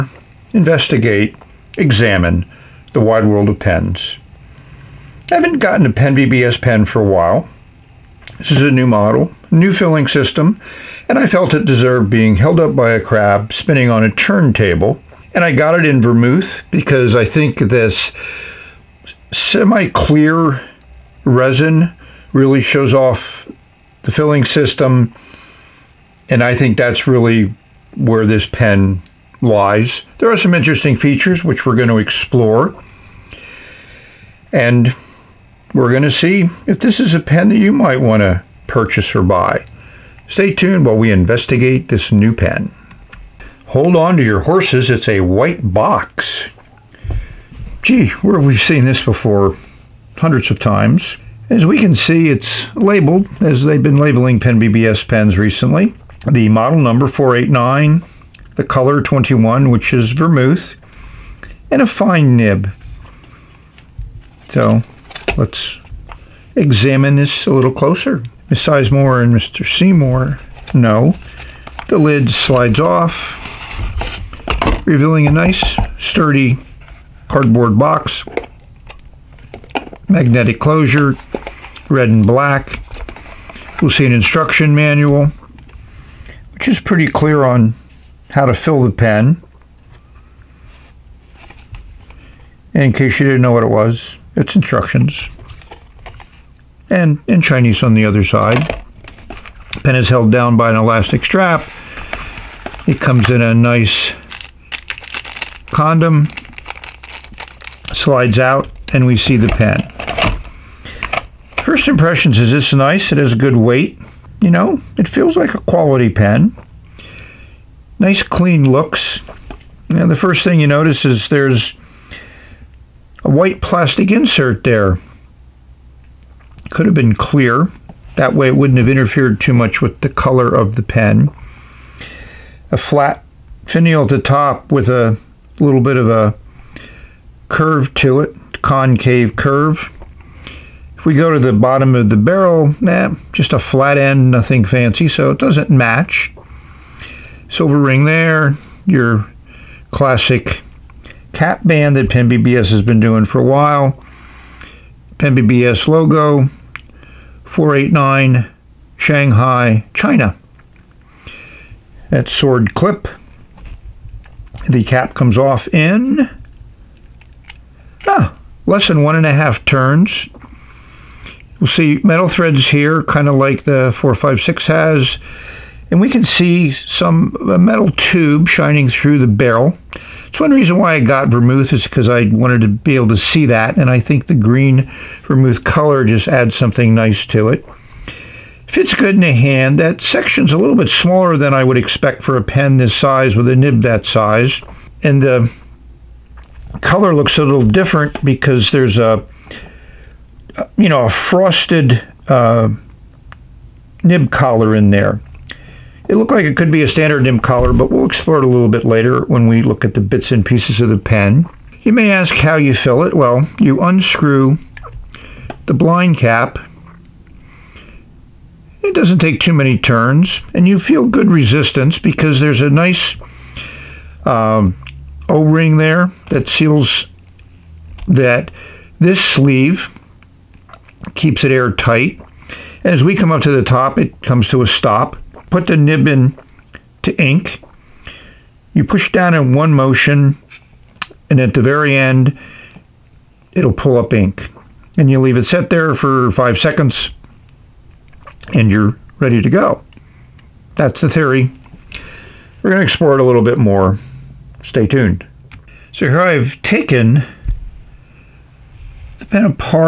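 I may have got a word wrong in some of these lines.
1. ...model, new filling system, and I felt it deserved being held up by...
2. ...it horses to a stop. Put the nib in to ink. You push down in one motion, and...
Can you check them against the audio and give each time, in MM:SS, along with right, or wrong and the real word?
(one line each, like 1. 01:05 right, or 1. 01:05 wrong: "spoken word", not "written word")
1. 00:08 right
2. 03:53 wrong: "comes", not "horses".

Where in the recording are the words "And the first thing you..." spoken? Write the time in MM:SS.
01:59.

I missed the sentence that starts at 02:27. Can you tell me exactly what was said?
Silver ring there, your classic cap band that Pen BBS has been doing for a while.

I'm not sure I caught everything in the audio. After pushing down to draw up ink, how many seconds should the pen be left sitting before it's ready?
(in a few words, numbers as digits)
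5.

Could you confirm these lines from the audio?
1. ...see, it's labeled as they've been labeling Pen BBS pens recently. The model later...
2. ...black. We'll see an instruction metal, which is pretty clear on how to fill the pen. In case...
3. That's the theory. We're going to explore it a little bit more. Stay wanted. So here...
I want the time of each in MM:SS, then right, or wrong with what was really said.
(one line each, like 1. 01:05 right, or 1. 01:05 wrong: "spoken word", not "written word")
1. 00:51 wrong: "number", not "later"
2. 01:22 wrong: "manual", not "metal"
3. 04:10 wrong: "tuned", not "wanted".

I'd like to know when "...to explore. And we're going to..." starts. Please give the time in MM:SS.
00:31.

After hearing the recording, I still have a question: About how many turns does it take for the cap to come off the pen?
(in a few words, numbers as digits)
One and a half.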